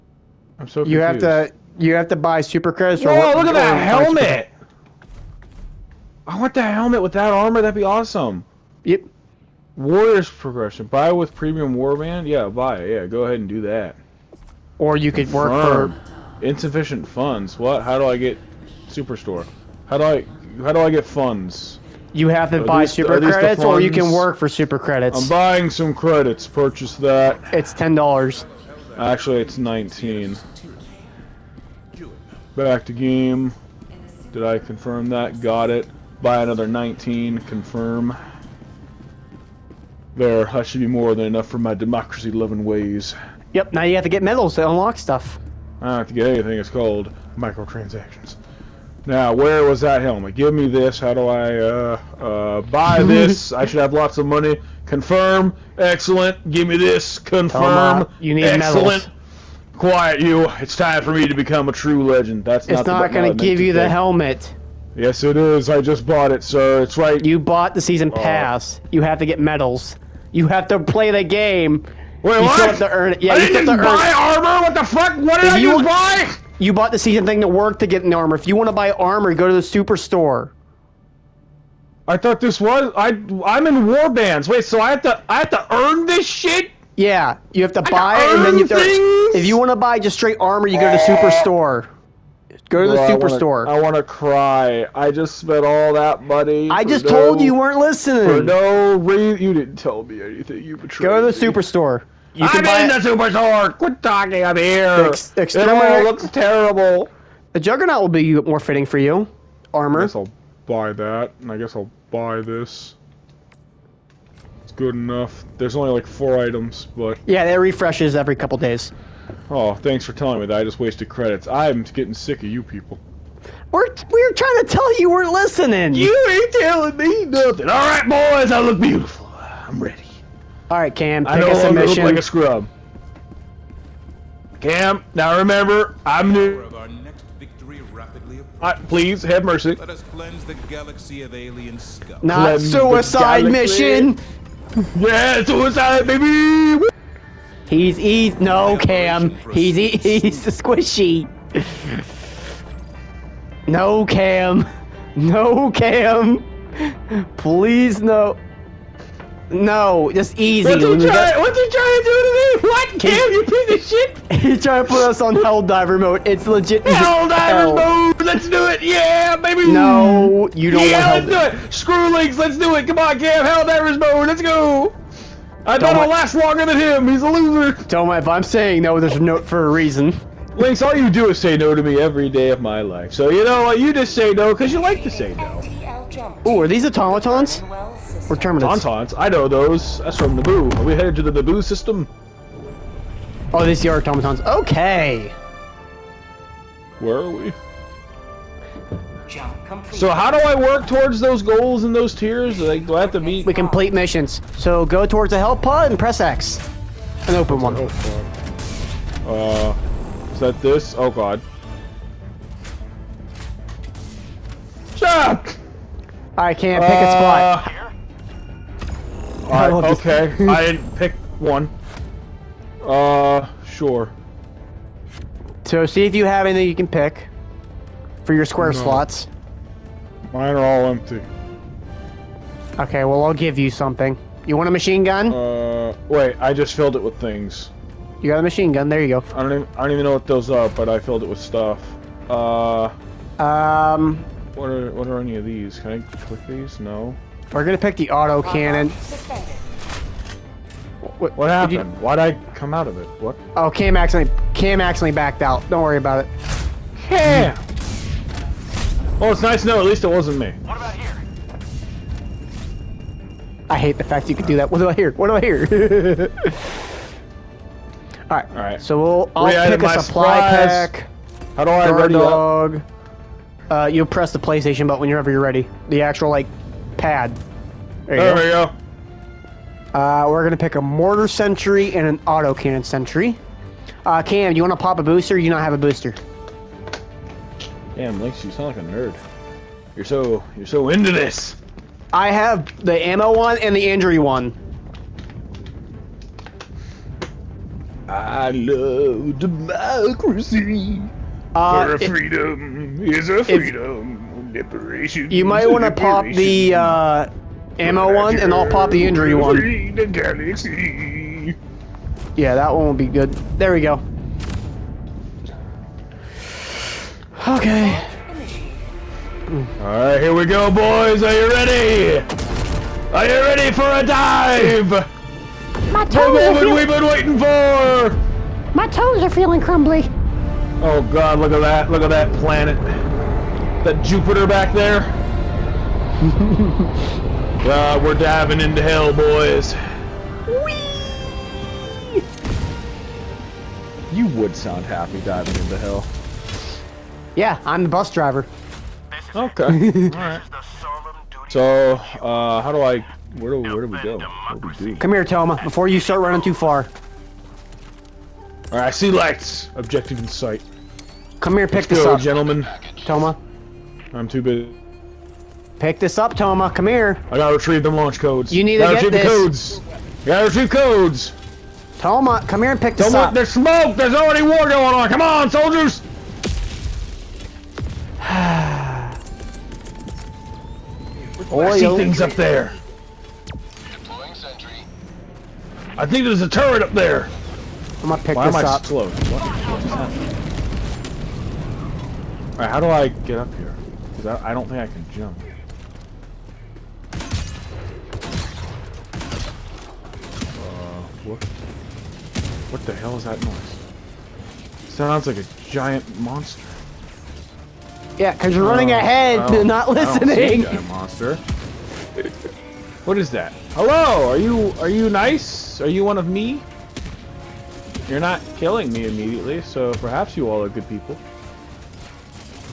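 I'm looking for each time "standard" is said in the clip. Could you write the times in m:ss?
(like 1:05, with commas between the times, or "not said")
not said.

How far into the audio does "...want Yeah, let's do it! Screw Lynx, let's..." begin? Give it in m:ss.
2:51.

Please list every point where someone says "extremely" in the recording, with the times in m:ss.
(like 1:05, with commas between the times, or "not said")
not said.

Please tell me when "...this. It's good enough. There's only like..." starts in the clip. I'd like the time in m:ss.
1:52.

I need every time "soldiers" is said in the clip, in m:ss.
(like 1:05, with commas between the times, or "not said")
6:15.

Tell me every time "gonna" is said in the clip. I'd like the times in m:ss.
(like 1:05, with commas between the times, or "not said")
4:07, 4:40, 6:28.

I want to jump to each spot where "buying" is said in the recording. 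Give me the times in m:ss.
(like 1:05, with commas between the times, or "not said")
0:25.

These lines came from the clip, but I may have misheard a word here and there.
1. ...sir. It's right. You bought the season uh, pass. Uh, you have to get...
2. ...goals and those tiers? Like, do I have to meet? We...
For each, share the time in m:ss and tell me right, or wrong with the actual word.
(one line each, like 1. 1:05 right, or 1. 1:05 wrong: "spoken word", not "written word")
1. 1:06 right
2. 3:21 right.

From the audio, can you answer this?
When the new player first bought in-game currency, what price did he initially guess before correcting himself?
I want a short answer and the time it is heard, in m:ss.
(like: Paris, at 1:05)
$10, at 0:27.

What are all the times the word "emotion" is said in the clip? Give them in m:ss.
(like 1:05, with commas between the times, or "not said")
not said.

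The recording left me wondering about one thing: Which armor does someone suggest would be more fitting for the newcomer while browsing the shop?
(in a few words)
juggernaut.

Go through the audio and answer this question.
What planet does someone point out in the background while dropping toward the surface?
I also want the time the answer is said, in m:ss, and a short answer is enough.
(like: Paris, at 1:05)
Jupiter, at 5:34.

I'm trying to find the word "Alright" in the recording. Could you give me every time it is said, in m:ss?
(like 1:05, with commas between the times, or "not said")
5:19, 5:49, 5:58.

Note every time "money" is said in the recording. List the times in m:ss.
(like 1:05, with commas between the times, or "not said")
0:54, 1:36.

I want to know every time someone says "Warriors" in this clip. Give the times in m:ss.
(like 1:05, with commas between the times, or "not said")
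0:09.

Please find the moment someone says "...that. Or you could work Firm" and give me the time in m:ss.
0:13.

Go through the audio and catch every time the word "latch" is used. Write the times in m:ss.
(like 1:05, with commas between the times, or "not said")
not said.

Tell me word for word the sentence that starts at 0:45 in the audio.
I don't have to get anything, it's called microtransactions.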